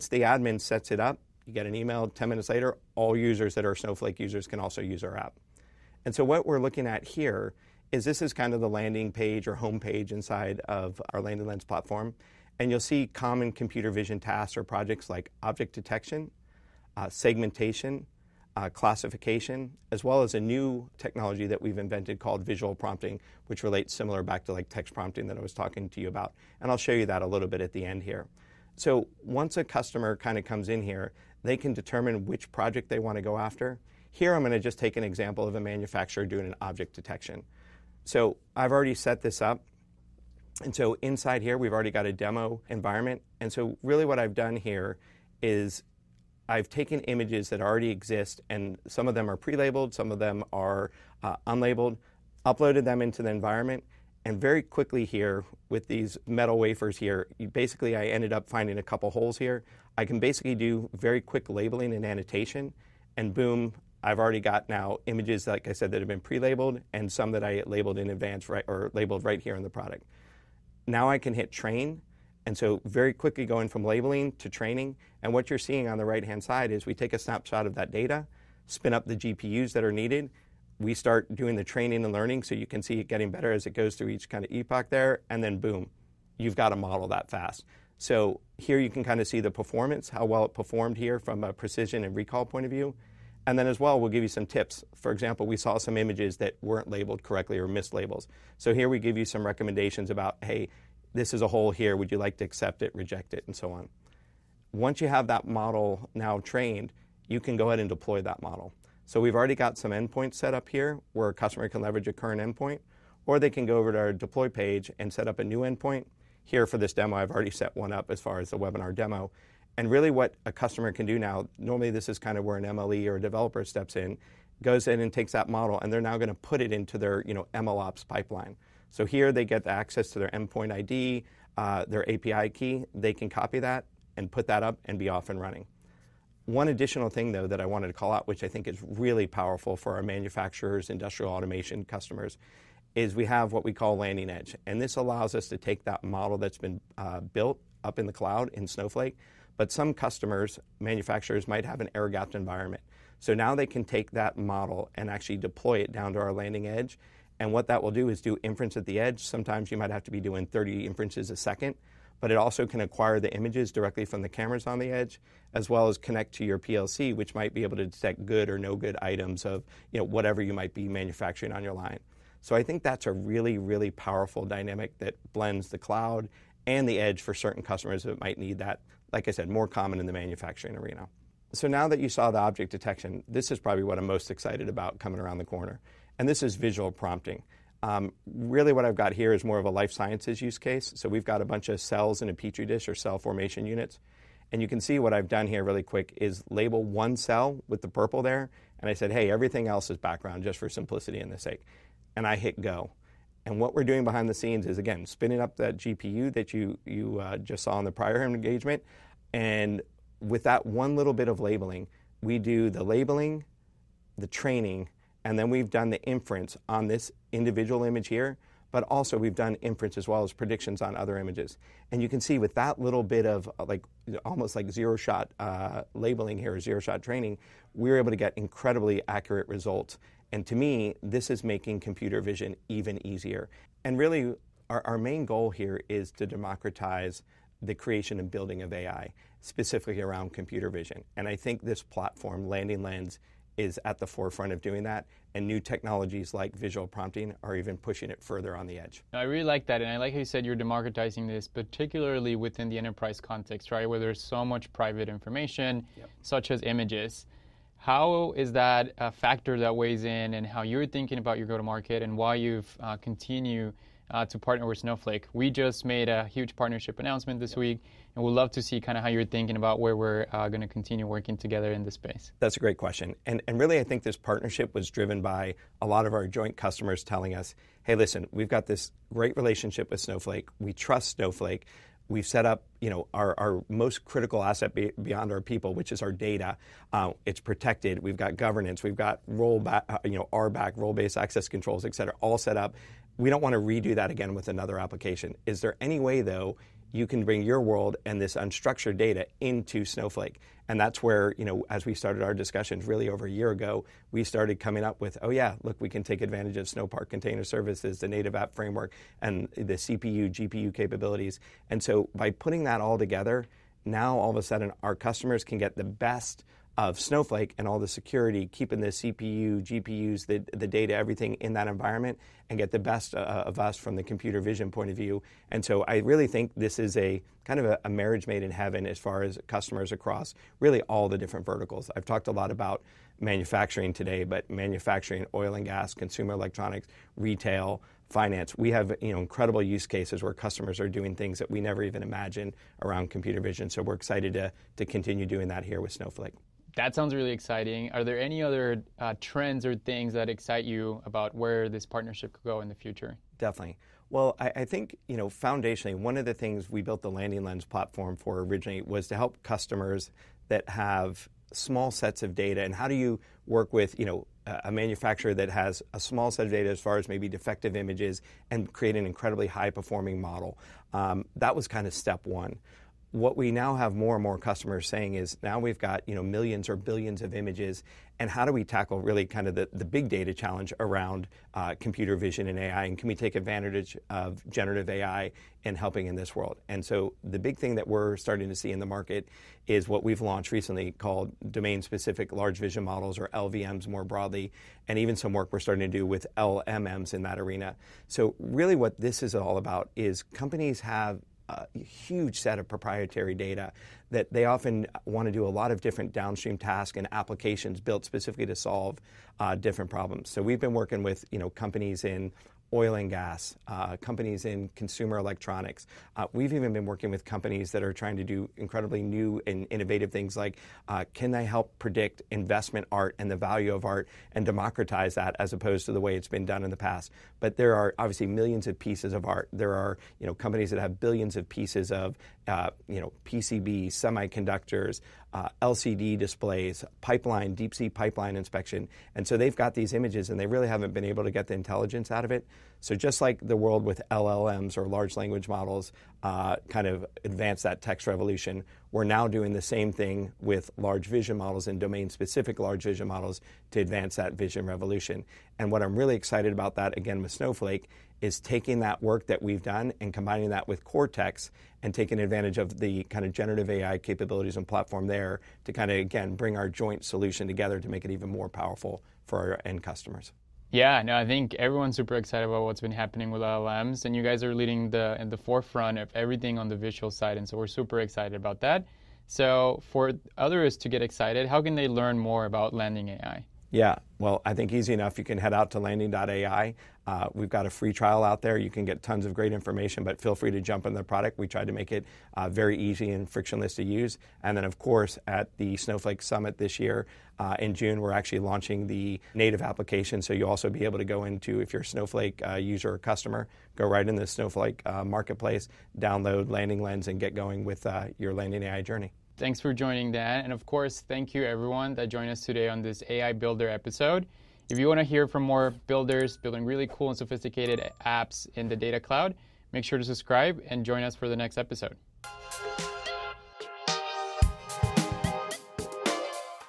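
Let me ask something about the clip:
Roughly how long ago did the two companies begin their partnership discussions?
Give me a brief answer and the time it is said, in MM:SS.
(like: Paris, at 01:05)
over a year ago, at 05:03.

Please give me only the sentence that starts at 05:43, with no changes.
So we're excited to, to continue doing that here with Snowflake that sounds really exciting.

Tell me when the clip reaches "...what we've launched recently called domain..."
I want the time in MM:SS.
06:29.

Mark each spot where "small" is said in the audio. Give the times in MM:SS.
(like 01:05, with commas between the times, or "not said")
06:01, 06:05.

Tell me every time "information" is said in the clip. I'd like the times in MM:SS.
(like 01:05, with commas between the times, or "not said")
04:15, 08:09.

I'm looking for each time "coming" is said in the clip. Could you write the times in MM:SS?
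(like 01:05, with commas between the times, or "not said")
03:04, 05:04.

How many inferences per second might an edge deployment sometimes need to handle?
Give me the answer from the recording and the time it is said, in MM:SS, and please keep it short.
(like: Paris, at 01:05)
30, at 02:40.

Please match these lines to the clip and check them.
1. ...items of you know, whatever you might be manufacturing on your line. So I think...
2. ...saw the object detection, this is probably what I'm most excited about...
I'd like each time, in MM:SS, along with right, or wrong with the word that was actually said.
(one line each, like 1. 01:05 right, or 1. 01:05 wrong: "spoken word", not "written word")
1. 02:49 right
2. 03:02 right.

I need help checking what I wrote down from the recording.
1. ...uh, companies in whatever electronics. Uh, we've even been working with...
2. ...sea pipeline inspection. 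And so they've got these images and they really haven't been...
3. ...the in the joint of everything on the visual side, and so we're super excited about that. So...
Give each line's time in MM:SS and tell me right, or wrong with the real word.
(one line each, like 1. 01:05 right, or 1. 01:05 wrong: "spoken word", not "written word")
1. 06:53 wrong: "consumer", not "whatever"
2. 07:17 right
3. 07:54 wrong: "forefront", not "joint".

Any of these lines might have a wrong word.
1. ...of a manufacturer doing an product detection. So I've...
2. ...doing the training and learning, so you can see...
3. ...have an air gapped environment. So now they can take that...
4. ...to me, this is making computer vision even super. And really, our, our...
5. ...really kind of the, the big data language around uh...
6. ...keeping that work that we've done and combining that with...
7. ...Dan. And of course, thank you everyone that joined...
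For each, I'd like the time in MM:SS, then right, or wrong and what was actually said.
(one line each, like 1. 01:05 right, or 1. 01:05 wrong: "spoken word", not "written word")
1. 00:35 wrong: "object", not "product"
2. 01:21 right
3. 02:31 right
4. 03:50 wrong: "easier", not "super"
5. 06:19 wrong: "challenge", not "language"
6. 07:38 wrong: "taking", not "keeping"
7. 08:30 right.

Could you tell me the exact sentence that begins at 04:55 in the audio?
Is there any way, though, you can bring your world and this unstructured data into Snowflake?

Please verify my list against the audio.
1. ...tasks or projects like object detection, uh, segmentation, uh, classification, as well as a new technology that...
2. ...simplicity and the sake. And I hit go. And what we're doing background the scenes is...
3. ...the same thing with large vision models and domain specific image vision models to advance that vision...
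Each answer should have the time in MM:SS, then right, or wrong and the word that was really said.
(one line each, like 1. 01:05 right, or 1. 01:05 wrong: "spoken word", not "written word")
1. 00:14 right
2. 03:20 wrong: "behind", not "background"
3. 07:29 wrong: "large", not "image".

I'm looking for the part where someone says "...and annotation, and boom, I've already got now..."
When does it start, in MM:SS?
01:01.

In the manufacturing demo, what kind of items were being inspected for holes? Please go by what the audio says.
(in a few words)
metal wafers.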